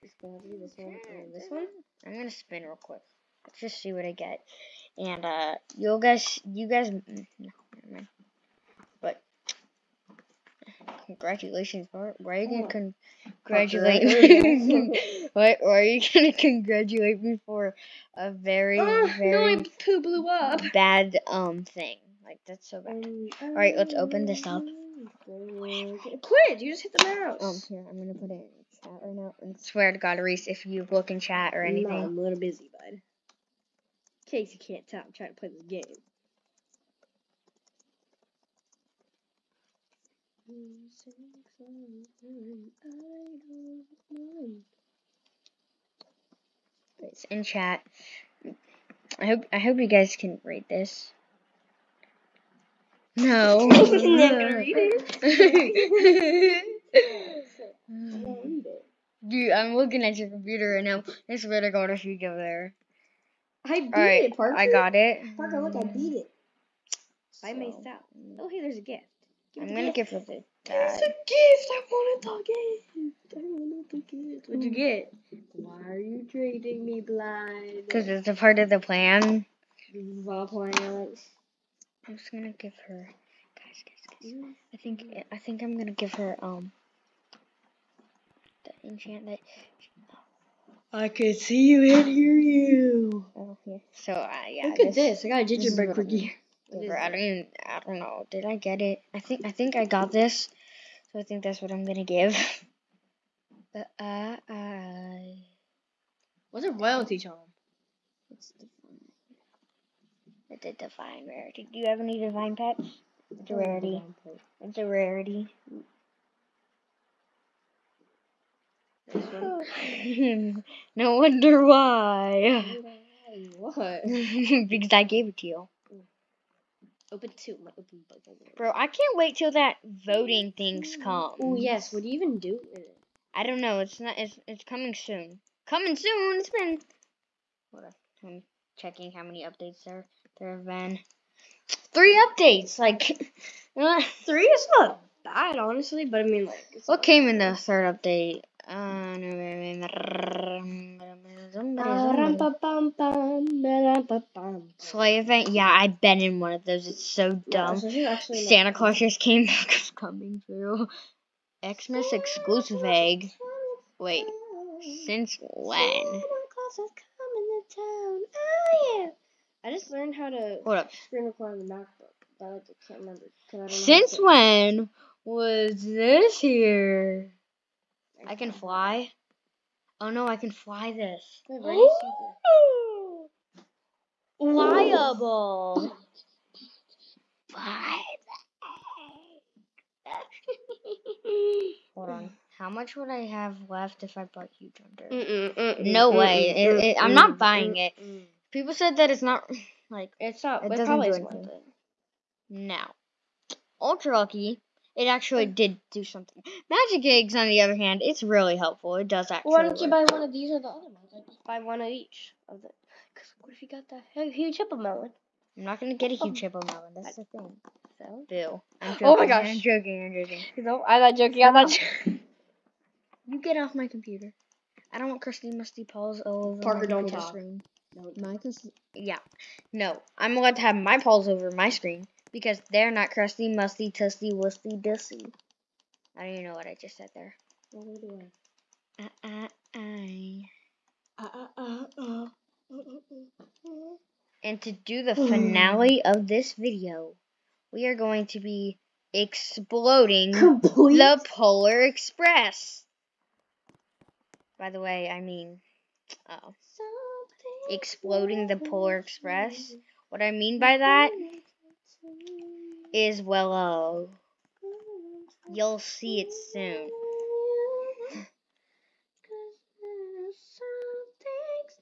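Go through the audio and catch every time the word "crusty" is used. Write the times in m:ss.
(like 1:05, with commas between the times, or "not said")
3:45, 3:53.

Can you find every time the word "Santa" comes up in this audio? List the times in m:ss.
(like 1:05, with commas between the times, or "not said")
2:38.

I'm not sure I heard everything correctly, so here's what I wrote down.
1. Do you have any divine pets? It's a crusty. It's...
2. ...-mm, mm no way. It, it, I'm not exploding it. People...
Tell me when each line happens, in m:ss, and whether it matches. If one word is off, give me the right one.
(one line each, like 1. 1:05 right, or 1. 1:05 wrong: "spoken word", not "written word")
1. 1:51 wrong: "rarity", not "crusty"
2. 3:15 wrong: "buying", not "exploding".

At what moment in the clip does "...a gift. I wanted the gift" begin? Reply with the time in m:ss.
1:11.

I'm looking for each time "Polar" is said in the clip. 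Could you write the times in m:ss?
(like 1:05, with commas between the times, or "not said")
4:11, 4:18.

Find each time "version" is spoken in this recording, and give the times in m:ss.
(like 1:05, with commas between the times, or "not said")
not said.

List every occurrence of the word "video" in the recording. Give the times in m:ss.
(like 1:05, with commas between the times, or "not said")
4:06.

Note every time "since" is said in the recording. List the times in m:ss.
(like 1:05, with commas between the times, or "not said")
2:45, 2:53.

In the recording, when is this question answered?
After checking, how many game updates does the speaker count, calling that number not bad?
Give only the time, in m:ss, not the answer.
2:21.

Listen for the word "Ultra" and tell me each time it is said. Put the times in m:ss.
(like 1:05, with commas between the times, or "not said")
3:23.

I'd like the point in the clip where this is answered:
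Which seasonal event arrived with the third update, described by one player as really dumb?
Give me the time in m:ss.
2:31.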